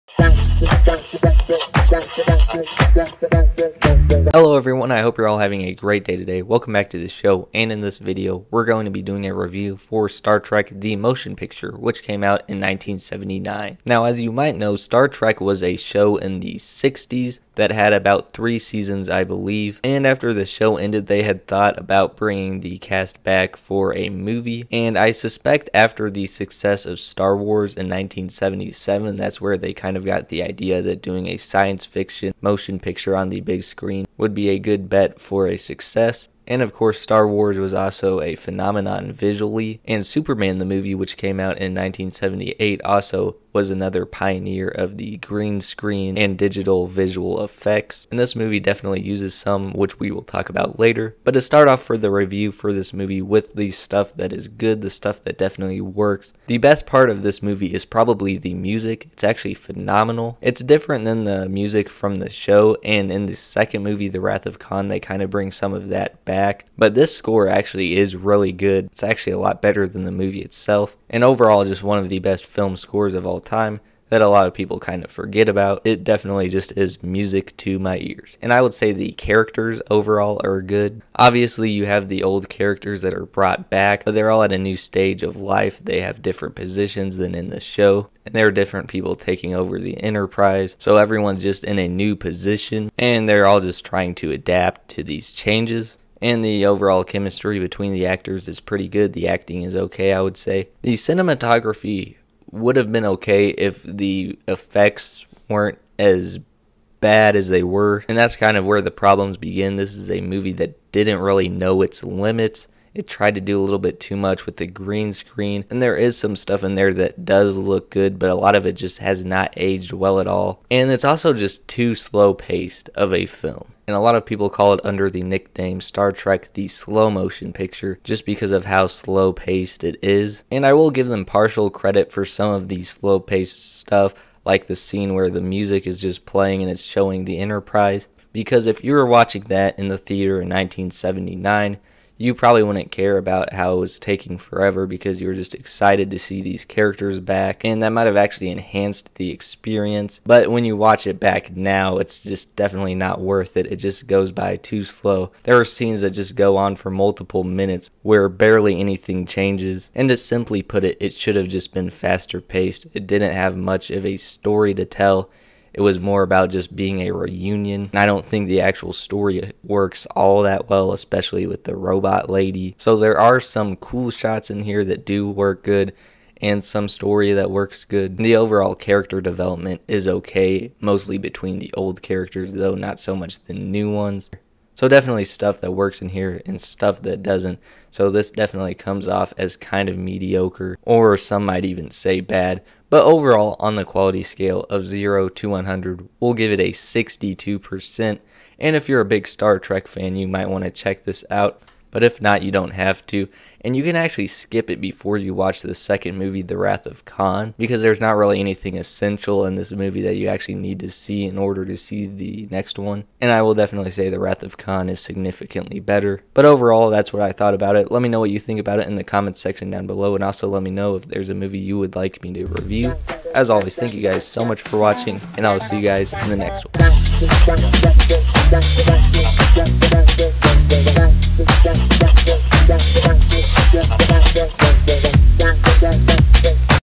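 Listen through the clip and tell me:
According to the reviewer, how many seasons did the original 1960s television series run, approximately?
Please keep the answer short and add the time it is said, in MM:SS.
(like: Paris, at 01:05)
3, at 00:18.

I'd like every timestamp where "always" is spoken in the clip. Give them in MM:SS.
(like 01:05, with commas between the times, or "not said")
03:43.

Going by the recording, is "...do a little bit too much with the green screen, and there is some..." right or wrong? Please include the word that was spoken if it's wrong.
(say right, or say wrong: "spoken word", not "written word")
right.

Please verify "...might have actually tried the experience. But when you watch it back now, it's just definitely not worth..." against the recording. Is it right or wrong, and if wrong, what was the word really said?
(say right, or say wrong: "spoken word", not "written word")
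wrong: "enhanced", not "tried".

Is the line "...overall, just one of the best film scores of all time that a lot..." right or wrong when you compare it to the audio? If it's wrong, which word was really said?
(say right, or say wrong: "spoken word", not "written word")
right.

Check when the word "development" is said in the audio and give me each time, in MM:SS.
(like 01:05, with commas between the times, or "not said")
02:59.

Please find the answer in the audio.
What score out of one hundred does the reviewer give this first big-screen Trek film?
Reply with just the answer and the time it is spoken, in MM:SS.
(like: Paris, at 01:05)
62%, at 03:16.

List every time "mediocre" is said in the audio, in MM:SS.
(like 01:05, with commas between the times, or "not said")
03:09.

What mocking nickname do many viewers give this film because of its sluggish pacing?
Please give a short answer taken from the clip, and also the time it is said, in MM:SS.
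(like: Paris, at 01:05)
Star Trek the slow motion picture, at 02:05.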